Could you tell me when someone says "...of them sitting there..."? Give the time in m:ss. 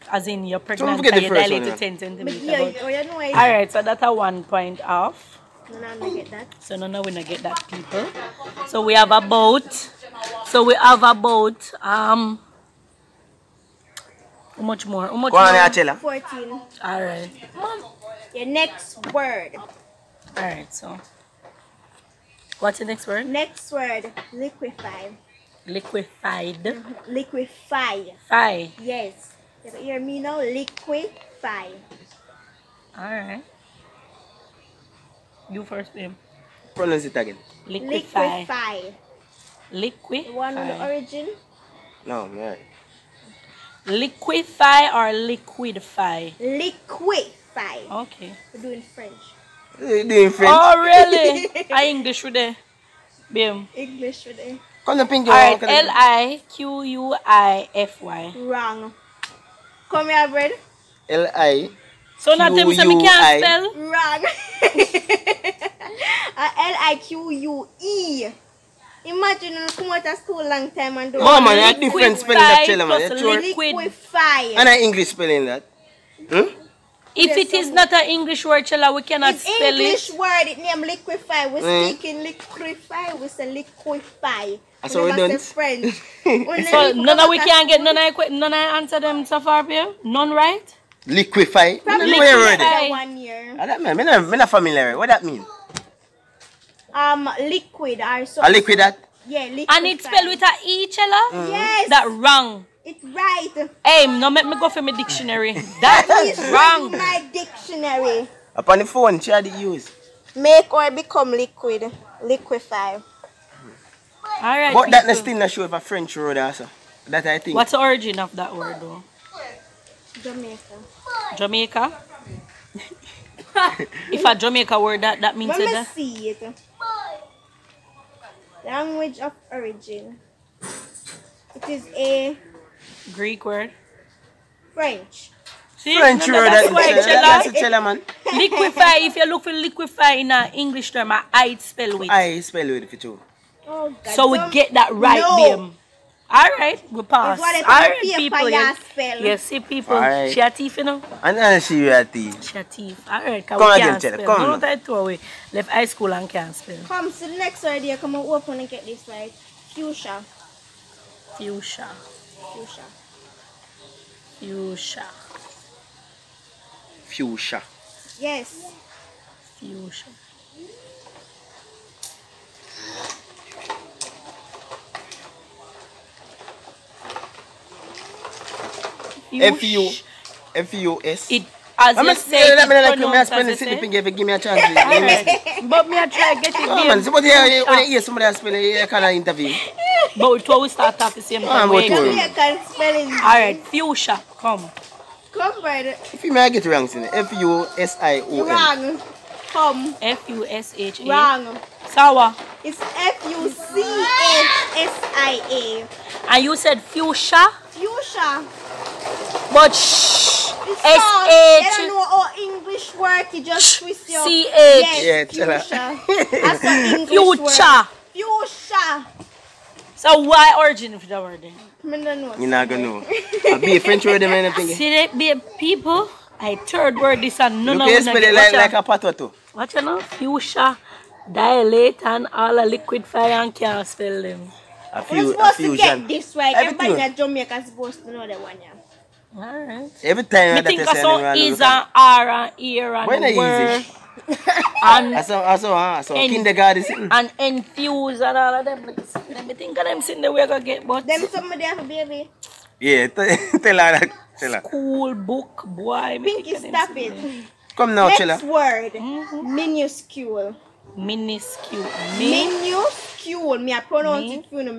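4:09.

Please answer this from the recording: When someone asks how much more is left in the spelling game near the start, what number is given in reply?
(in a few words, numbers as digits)
14.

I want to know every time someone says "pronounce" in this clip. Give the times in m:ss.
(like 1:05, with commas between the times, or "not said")
0:36, 4:23.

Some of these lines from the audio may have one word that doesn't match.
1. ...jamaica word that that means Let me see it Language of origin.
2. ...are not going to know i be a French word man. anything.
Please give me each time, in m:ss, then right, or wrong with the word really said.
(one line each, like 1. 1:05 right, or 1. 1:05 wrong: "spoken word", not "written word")
1. 2:04 right
2. 3:42 right.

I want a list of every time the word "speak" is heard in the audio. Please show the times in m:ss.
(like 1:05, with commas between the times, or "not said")
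1:21.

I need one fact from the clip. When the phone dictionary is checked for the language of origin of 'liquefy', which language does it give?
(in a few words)
Greek.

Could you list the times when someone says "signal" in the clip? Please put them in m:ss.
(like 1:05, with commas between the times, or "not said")
not said.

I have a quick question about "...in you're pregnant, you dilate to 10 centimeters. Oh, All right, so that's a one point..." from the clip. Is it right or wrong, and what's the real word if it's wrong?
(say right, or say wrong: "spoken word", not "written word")
right.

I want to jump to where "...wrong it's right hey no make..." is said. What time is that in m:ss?
1:42.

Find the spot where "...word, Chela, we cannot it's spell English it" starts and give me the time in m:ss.
1:18.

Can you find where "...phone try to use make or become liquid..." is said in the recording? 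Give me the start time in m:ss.
1:48.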